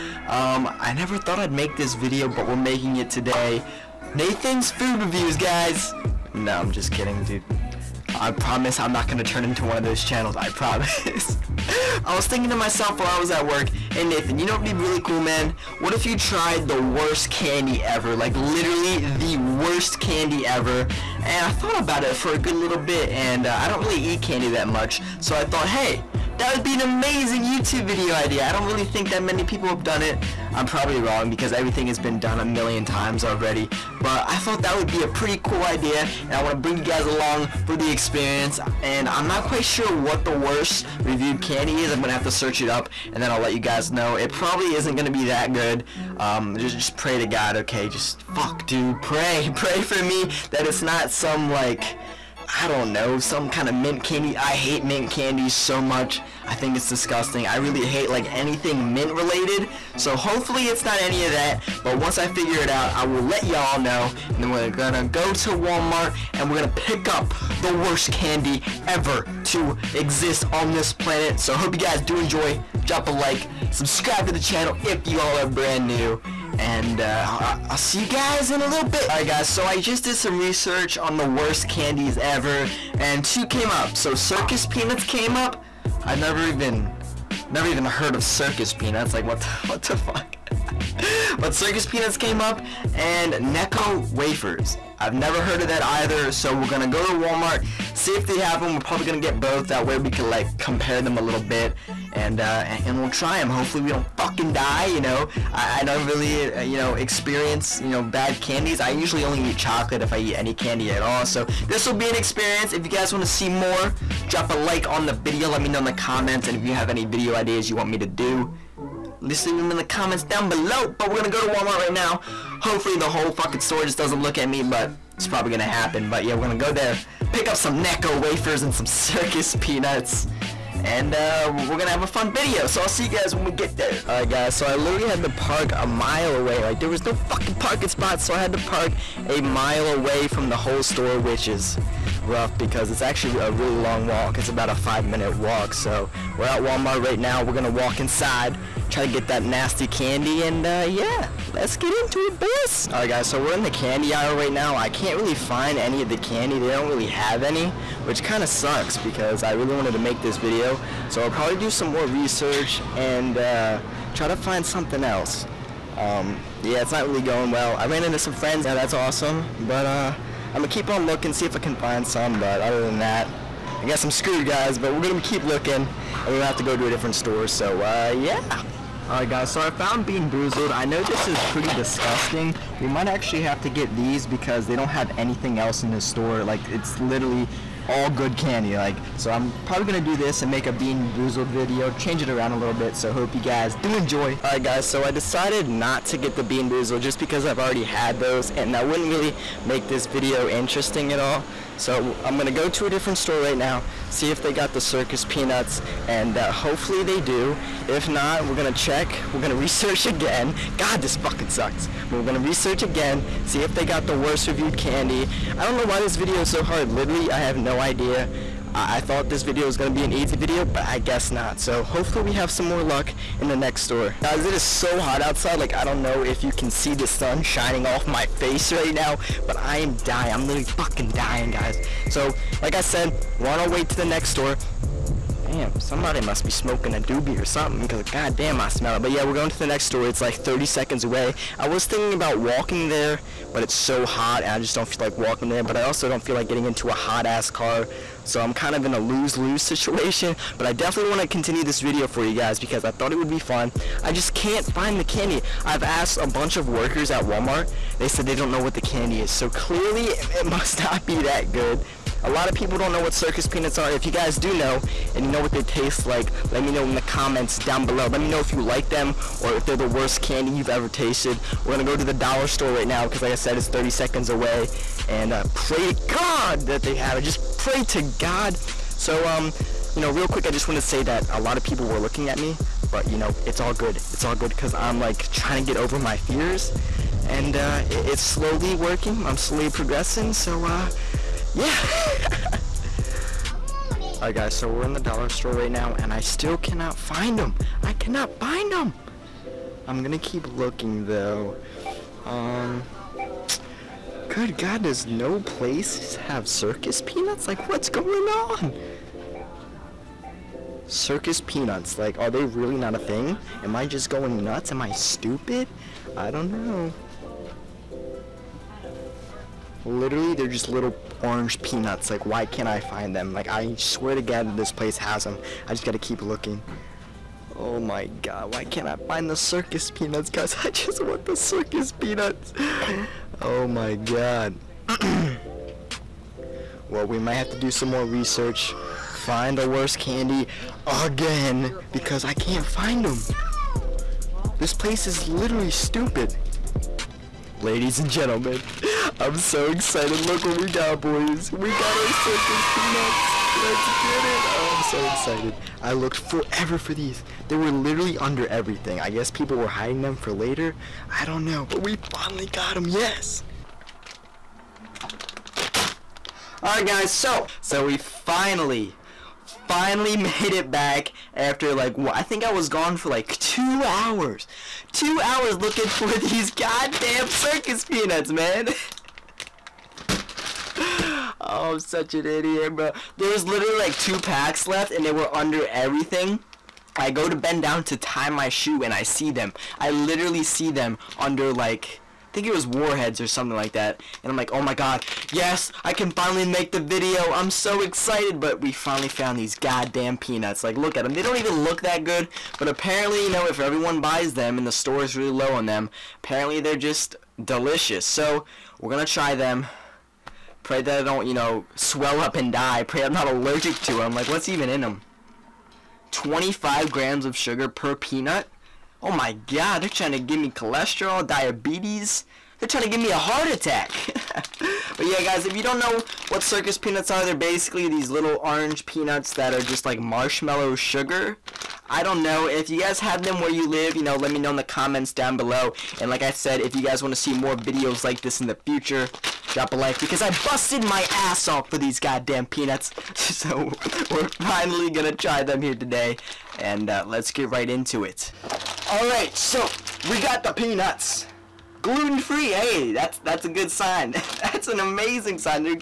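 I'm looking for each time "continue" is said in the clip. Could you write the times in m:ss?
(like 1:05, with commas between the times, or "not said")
4:11.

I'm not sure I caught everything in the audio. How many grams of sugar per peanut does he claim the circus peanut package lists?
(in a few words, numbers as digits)
25.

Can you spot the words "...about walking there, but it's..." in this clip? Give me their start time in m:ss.
4:02.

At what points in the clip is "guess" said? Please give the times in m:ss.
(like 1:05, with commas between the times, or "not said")
2:53, 3:40, 5:59.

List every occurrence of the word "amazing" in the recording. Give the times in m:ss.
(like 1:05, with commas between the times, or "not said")
0:26, 7:34.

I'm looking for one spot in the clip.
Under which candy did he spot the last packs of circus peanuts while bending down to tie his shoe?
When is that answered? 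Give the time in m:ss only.
6:32.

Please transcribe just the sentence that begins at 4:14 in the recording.
I just can't find the candy.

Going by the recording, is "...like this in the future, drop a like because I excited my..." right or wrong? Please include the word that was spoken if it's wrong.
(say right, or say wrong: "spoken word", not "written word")
wrong: "busted", not "excited".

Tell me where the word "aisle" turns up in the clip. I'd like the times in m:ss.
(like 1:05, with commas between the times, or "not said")
2:34.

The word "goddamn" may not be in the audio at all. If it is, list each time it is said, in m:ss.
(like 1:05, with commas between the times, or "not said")
3:58, 6:16, 6:39, 7:21.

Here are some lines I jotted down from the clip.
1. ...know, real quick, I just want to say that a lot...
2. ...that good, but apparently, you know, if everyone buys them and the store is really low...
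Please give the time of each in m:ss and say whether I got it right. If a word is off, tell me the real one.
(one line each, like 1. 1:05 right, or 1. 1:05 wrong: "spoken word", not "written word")
1. 4:39 right
2. 6:41 right.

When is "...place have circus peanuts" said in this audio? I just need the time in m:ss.
5:05.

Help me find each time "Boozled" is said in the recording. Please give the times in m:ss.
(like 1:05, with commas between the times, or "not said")
3:00, 3:11, 3:16.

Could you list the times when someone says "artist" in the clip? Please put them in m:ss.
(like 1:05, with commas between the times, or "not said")
not said.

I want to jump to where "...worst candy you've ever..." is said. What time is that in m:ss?
4:29.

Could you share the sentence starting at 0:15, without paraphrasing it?
What if you tried the worst candy ever?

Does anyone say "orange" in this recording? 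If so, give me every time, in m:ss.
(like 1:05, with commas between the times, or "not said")
5:21, 7:08.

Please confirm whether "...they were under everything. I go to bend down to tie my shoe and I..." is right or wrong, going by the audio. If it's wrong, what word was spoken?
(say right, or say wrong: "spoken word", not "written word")
right.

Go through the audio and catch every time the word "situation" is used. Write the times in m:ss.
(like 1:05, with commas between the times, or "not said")
4:09.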